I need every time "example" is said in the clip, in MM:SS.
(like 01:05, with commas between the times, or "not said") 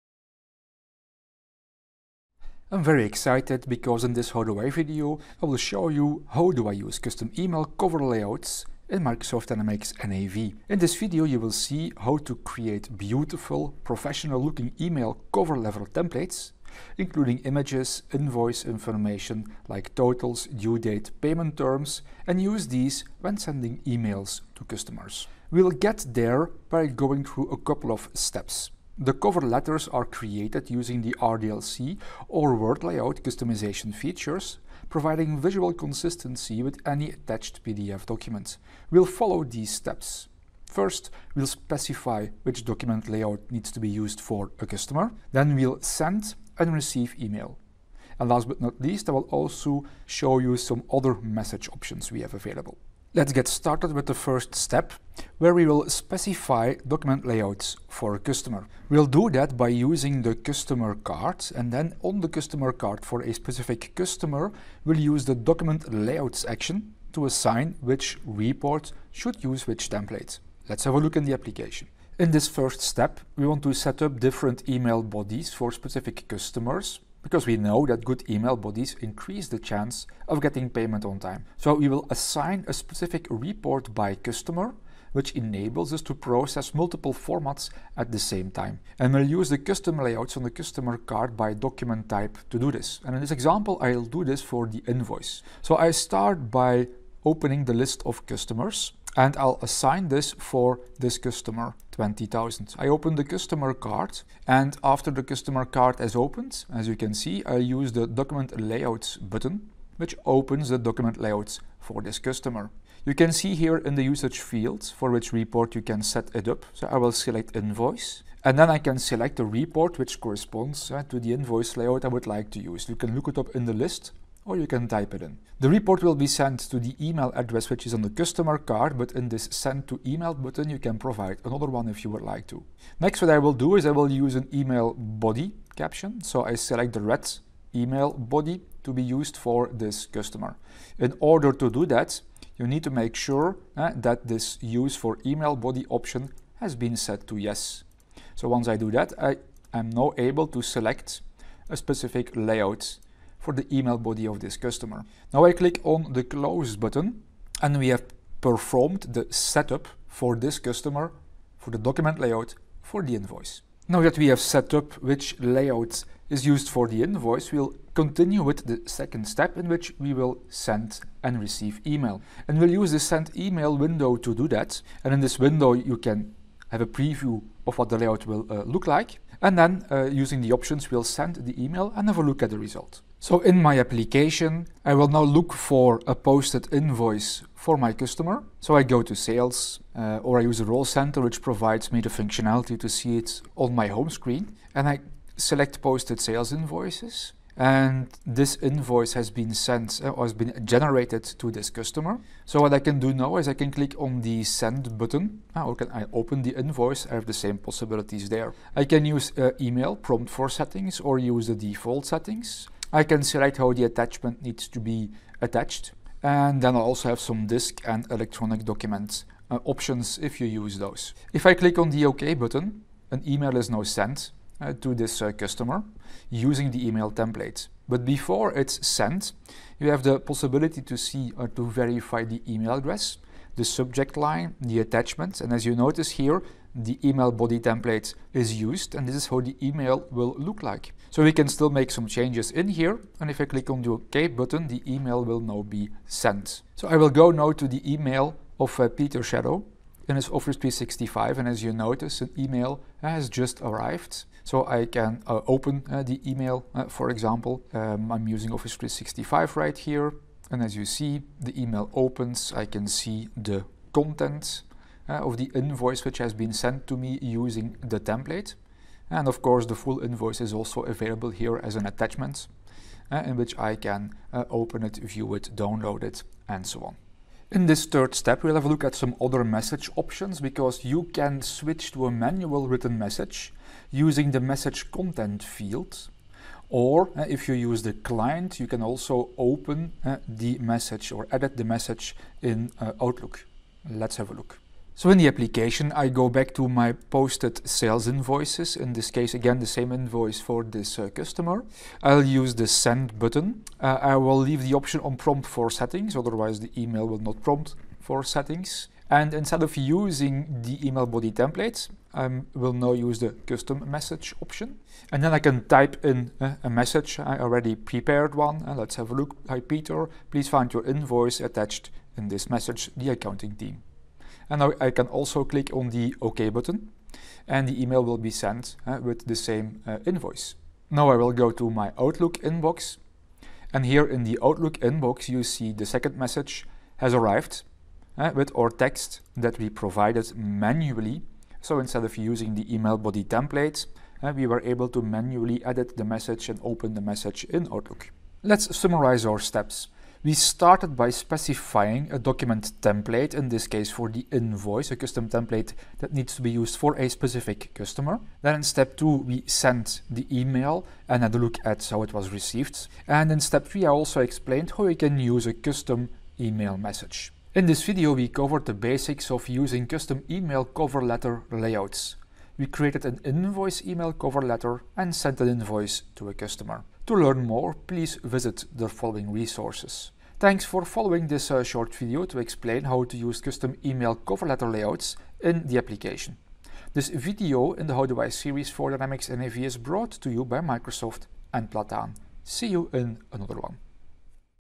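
01:33, 04:17.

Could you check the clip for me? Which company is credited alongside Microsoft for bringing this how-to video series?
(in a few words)
Plataan.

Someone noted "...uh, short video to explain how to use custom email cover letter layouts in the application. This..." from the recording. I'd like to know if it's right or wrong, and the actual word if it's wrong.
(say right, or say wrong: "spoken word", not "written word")
right.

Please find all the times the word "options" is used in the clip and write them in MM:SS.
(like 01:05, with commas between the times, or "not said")
00:51, 02:25, 03:00, 03:39, 04:39, 05:04, 05:14.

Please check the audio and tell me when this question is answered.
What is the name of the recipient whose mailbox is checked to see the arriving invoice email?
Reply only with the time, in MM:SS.
04:08.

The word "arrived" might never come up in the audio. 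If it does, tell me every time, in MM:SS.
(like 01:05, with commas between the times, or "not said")
04:13, 05:37.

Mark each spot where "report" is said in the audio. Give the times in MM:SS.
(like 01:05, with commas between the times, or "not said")
01:08, 01:23, 01:55, 01:59, 02:05.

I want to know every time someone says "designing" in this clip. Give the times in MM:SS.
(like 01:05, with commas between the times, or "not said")
not said.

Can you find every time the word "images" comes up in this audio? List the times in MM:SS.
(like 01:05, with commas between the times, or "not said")
00:17.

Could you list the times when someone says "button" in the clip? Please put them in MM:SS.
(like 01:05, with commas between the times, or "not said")
01:49, 02:10, 02:36, 03:24, 03:42, 04:04, 05:03, 05:26.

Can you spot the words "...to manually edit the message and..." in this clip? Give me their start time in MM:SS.
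05:44.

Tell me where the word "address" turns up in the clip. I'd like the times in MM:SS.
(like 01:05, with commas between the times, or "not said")
02:07, 03:52.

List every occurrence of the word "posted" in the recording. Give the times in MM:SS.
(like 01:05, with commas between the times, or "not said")
03:06, 03:15, 04:56.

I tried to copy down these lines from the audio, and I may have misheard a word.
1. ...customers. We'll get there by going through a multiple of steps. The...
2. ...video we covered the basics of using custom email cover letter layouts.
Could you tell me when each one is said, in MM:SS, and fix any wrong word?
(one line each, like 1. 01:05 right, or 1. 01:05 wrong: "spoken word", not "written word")
1. 00:24 wrong: "couple", not "multiple"
2. 06:07 right.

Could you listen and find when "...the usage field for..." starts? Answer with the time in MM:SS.
01:53.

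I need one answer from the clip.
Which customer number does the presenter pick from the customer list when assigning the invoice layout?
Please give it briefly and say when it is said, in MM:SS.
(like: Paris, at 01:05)
20,000, at 01:42.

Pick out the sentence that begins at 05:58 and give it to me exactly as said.
Then in step two, we sent the email and had a look at how it was received.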